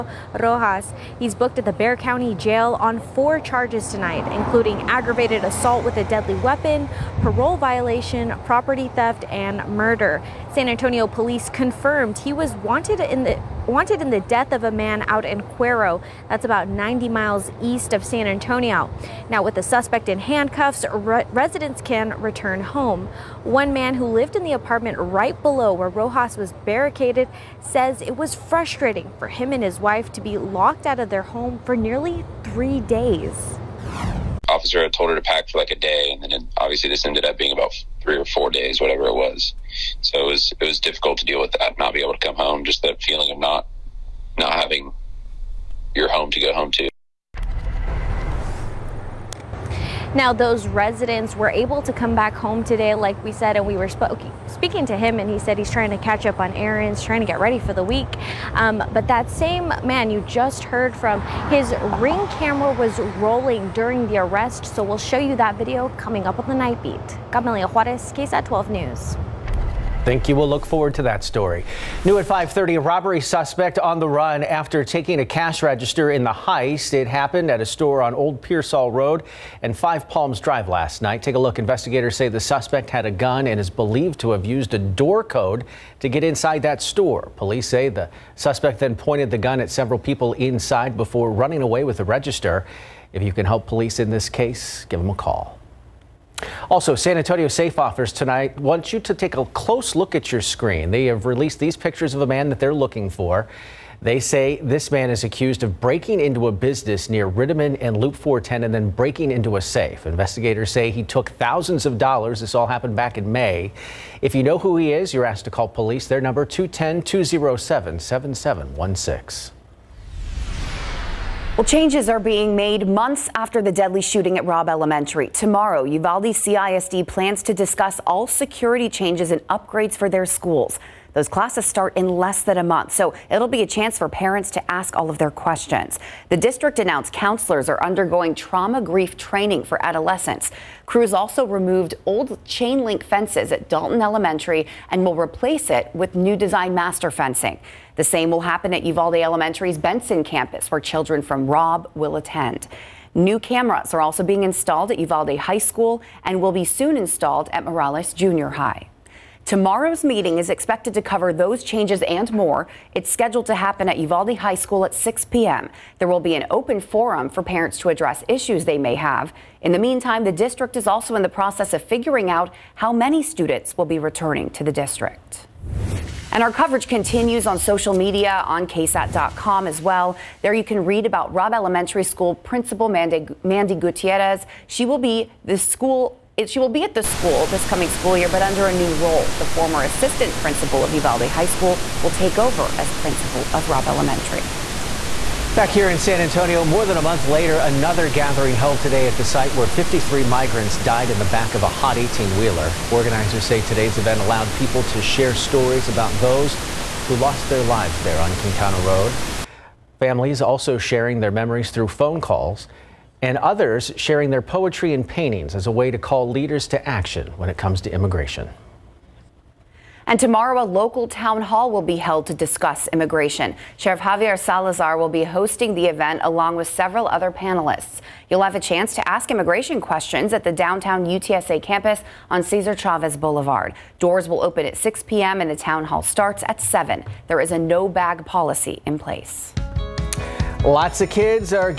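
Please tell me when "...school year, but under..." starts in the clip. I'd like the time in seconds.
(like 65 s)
187 s.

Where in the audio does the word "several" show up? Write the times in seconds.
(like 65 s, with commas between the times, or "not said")
89 s, 226 s.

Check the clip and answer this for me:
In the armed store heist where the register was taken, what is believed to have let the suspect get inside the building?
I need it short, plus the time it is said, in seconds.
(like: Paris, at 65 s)
a door code, at 84 s.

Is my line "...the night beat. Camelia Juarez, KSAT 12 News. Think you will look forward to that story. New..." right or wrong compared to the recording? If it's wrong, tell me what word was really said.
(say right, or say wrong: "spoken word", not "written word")
right.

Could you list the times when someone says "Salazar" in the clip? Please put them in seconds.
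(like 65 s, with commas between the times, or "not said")
224 s.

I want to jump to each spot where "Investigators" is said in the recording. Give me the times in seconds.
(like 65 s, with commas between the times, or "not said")
81 s, 110 s.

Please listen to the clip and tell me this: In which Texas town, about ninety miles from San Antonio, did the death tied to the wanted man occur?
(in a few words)
Cuero.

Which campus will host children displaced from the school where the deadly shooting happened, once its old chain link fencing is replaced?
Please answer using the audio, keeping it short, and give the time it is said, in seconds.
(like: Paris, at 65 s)
Benson campus, at 149 s.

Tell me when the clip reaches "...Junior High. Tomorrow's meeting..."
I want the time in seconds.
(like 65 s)
158 s.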